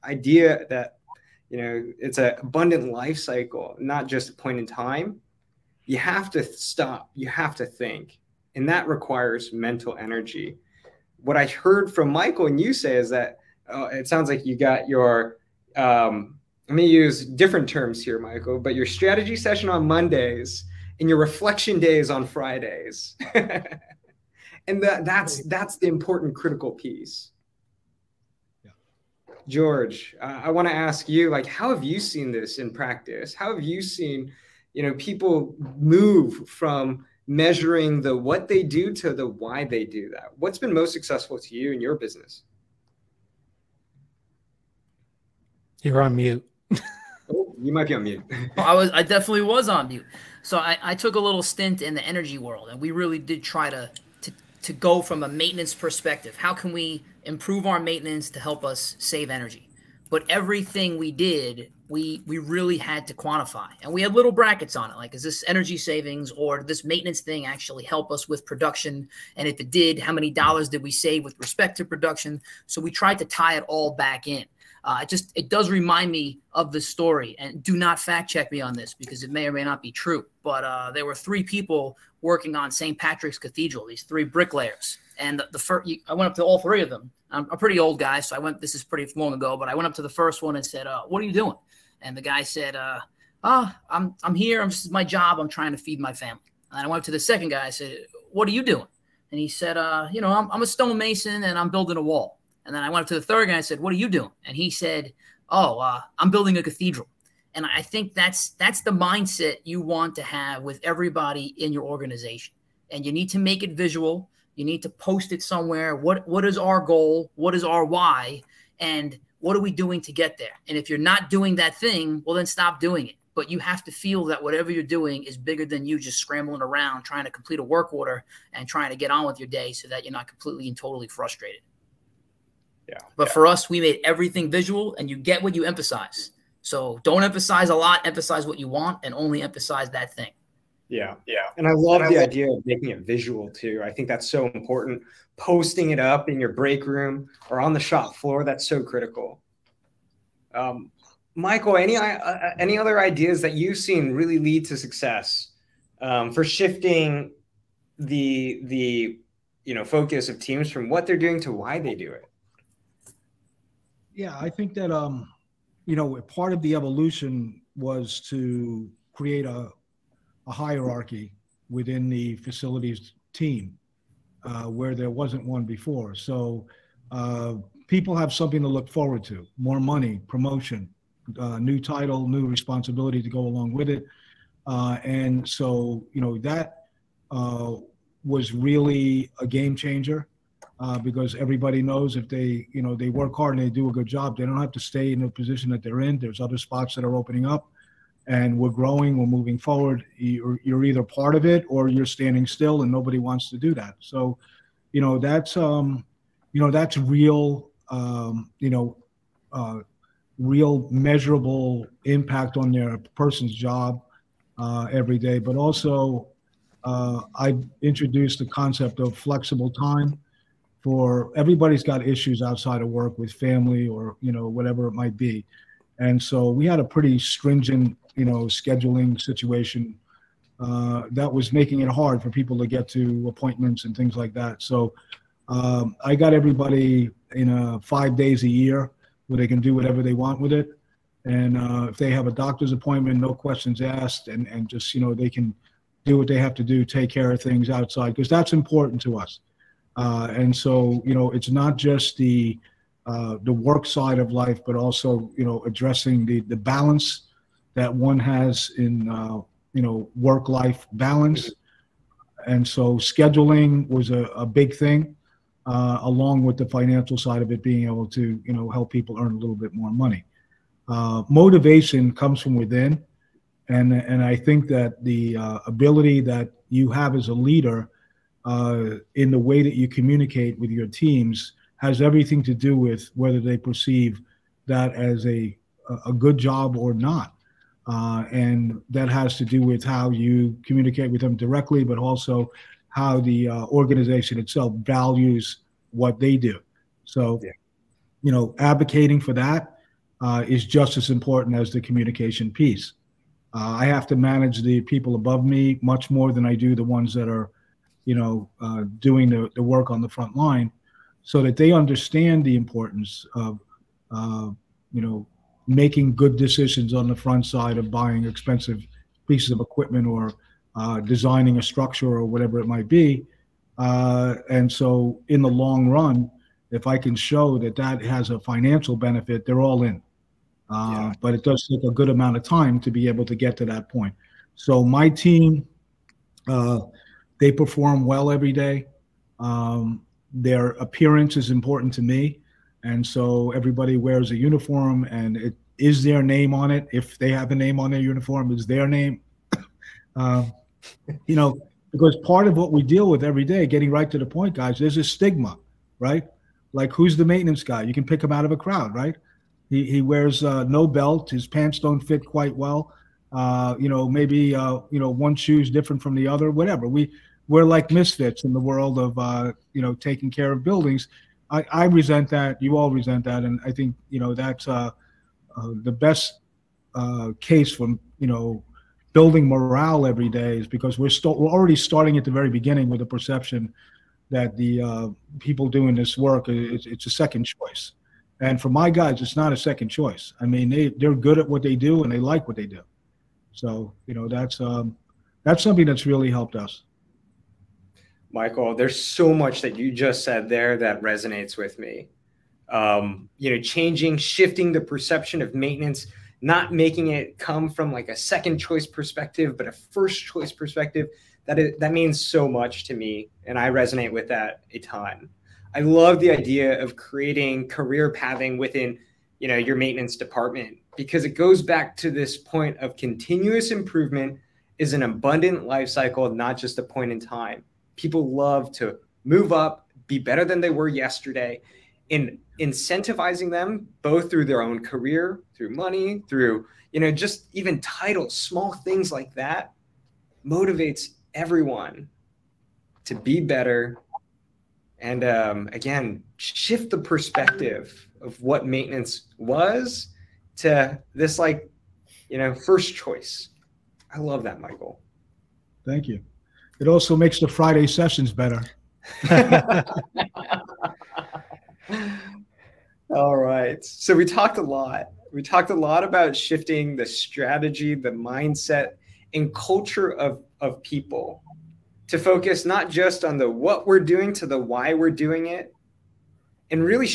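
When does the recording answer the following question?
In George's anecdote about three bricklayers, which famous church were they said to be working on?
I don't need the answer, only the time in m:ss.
1:22.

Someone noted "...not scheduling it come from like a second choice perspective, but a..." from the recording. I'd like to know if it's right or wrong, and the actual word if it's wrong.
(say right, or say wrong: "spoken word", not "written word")
wrong: "making", not "scheduling".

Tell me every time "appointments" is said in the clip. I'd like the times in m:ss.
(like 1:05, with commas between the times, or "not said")
3:53, 4:02.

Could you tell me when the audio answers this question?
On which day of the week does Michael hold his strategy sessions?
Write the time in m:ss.
0:19.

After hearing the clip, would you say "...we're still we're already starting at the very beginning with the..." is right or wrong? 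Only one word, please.
right.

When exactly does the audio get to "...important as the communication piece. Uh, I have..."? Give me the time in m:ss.
5:01.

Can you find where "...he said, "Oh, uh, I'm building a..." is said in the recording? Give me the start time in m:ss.
1:44.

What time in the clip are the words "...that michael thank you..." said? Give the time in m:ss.
7:34.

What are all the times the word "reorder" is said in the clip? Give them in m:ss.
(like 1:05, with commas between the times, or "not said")
not said.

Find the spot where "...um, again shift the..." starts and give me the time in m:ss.
7:25.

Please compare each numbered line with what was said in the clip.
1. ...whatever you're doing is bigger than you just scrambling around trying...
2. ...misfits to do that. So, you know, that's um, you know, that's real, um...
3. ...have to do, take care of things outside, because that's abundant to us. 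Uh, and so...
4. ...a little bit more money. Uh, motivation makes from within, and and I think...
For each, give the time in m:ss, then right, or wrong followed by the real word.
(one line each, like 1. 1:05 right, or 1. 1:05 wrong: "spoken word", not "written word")
1. 2:04 right
2. 3:23 wrong: "wants", not "misfits"
3. 4:06 wrong: "important", not "abundant"
4. 4:29 wrong: "comes", not "makes".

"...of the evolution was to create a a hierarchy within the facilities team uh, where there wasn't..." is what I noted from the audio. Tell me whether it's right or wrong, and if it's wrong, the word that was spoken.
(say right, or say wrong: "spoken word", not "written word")
right.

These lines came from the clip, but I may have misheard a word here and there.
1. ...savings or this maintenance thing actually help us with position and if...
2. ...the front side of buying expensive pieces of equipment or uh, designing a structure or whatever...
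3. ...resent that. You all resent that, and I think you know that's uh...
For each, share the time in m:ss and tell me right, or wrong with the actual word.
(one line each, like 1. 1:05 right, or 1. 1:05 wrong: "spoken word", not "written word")
1. 1:05 wrong: "production", not "position"
2. 5:17 right
3. 6:11 right.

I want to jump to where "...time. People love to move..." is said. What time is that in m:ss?
7:07.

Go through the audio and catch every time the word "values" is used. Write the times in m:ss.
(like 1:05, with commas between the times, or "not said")
4:54.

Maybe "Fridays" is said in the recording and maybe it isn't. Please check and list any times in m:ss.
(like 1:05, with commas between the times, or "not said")
0:22, 7:37.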